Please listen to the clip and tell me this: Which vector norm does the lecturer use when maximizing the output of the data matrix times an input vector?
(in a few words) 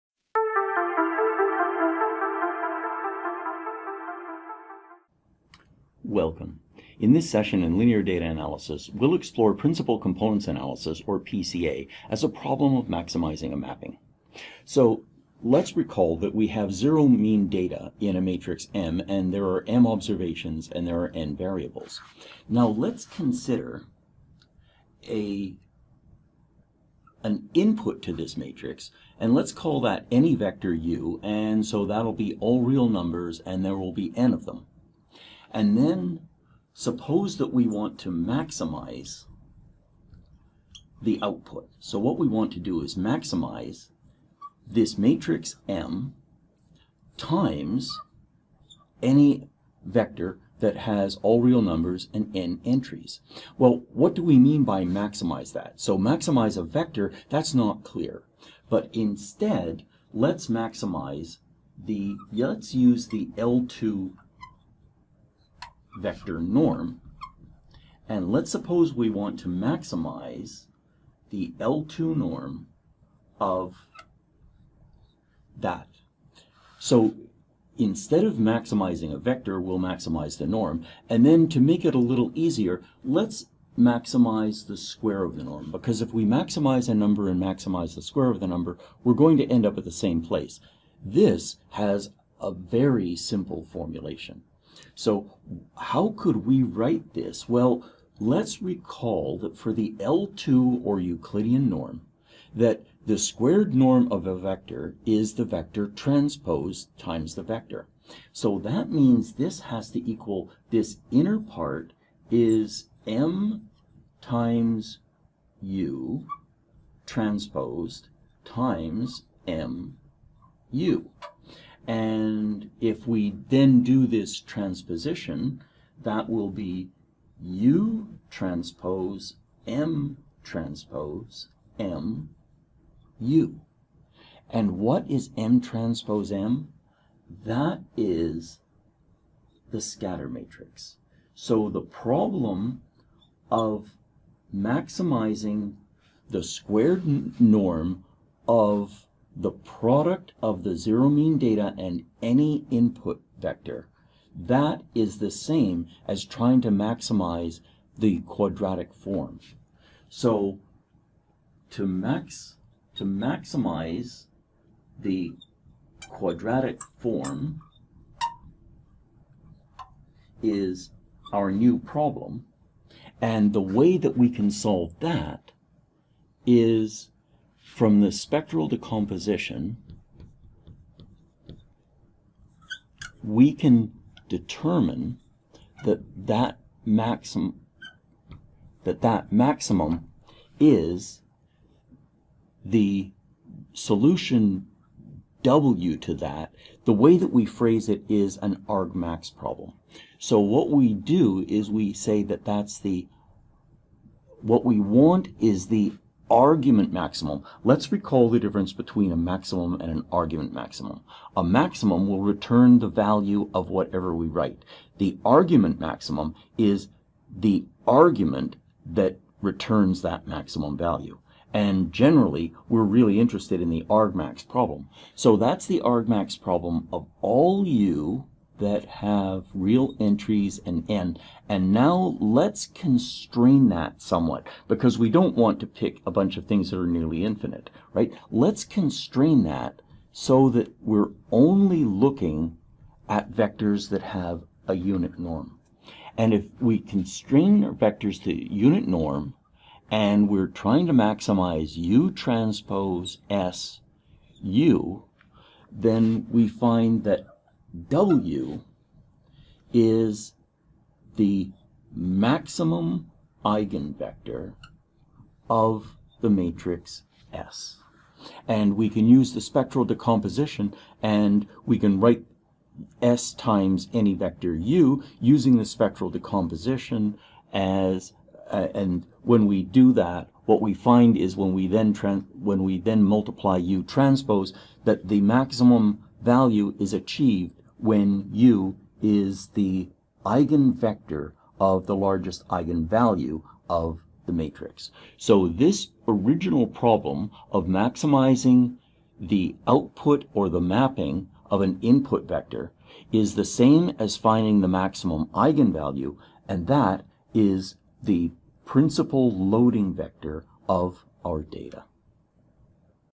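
L2 vector norm.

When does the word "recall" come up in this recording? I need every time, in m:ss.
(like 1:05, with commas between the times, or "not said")
0:15, 1:38, 3:27.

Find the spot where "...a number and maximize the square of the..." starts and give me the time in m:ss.
1:26.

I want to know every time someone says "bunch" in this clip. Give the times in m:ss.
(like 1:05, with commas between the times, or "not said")
3:56.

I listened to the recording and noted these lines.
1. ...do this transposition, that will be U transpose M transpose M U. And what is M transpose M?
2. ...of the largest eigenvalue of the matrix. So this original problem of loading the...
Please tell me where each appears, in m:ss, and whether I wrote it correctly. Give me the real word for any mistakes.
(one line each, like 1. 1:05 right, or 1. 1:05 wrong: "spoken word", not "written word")
1. 2:03 right
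2. 4:51 wrong: "maximizing", not "loading".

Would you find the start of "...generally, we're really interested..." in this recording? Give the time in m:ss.
3:41.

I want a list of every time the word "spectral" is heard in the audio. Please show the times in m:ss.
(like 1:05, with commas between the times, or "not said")
2:58, 4:29, 4:35.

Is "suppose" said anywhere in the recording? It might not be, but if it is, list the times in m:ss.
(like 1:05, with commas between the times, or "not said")
0:36, 1:08.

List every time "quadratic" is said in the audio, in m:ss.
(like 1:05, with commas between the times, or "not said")
2:38, 2:46.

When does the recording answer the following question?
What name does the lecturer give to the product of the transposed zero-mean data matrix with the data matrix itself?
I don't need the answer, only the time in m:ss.
2:19.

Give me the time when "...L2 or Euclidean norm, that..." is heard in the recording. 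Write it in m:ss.
1:39.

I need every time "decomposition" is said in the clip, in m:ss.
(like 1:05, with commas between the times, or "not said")
2:58, 4:29, 4:36.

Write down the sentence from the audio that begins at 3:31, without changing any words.
A maximum will return the value of whatever we write.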